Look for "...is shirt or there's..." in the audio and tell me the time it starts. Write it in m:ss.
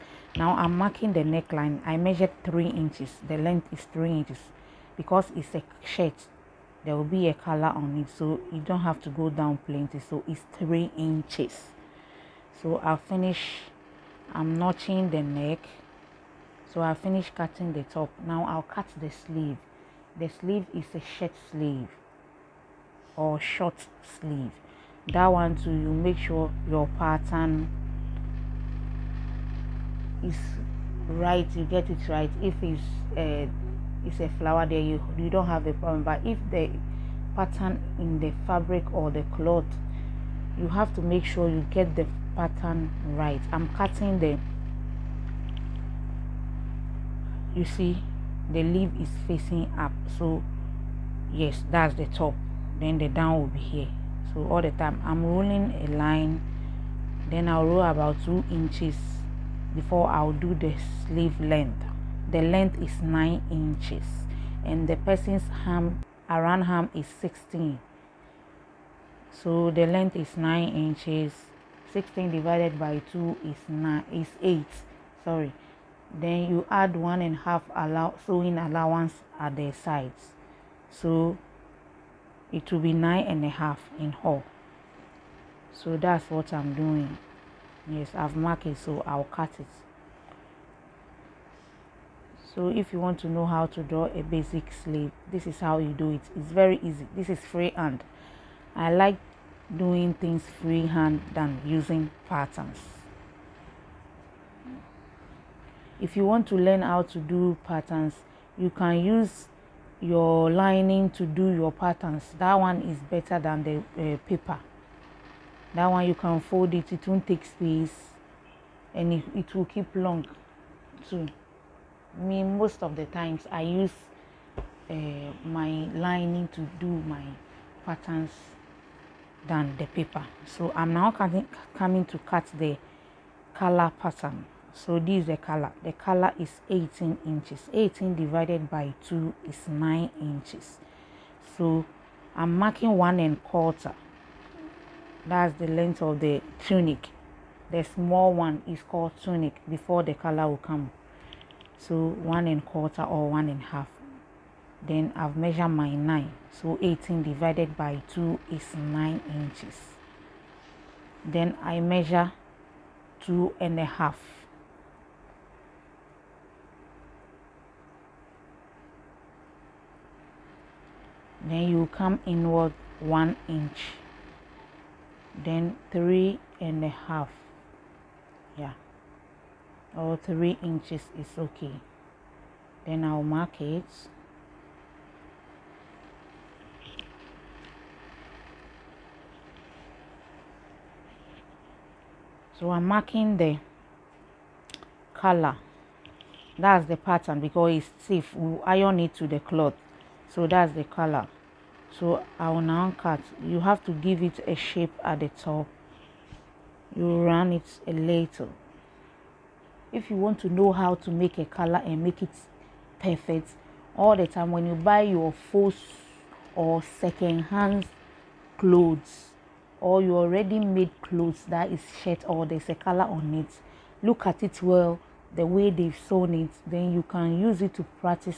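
3:41.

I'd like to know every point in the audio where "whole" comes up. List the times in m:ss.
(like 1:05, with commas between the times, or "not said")
1:24.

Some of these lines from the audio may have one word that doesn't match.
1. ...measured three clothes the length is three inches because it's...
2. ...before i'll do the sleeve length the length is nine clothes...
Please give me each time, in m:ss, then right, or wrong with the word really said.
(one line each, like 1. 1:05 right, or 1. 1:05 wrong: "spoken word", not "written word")
1. 0:01 wrong: "inches", not "clothes"
2. 0:59 wrong: "inches", not "clothes".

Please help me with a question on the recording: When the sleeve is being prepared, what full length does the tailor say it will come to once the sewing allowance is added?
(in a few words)
9 and a half inches.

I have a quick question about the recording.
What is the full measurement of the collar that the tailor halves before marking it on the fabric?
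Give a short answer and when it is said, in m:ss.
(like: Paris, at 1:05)
18 inches, at 2:16.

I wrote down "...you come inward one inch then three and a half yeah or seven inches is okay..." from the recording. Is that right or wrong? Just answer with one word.
wrong.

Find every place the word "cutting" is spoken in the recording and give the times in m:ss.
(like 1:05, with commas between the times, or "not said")
0:17, 0:43.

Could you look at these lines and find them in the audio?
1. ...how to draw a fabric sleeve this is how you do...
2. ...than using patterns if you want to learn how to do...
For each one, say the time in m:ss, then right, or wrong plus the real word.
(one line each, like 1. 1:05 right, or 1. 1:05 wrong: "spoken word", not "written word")
1. 1:33 wrong: "basic", not "fabric"
2. 1:41 right.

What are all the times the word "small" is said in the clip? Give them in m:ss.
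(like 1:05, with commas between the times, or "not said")
2:27.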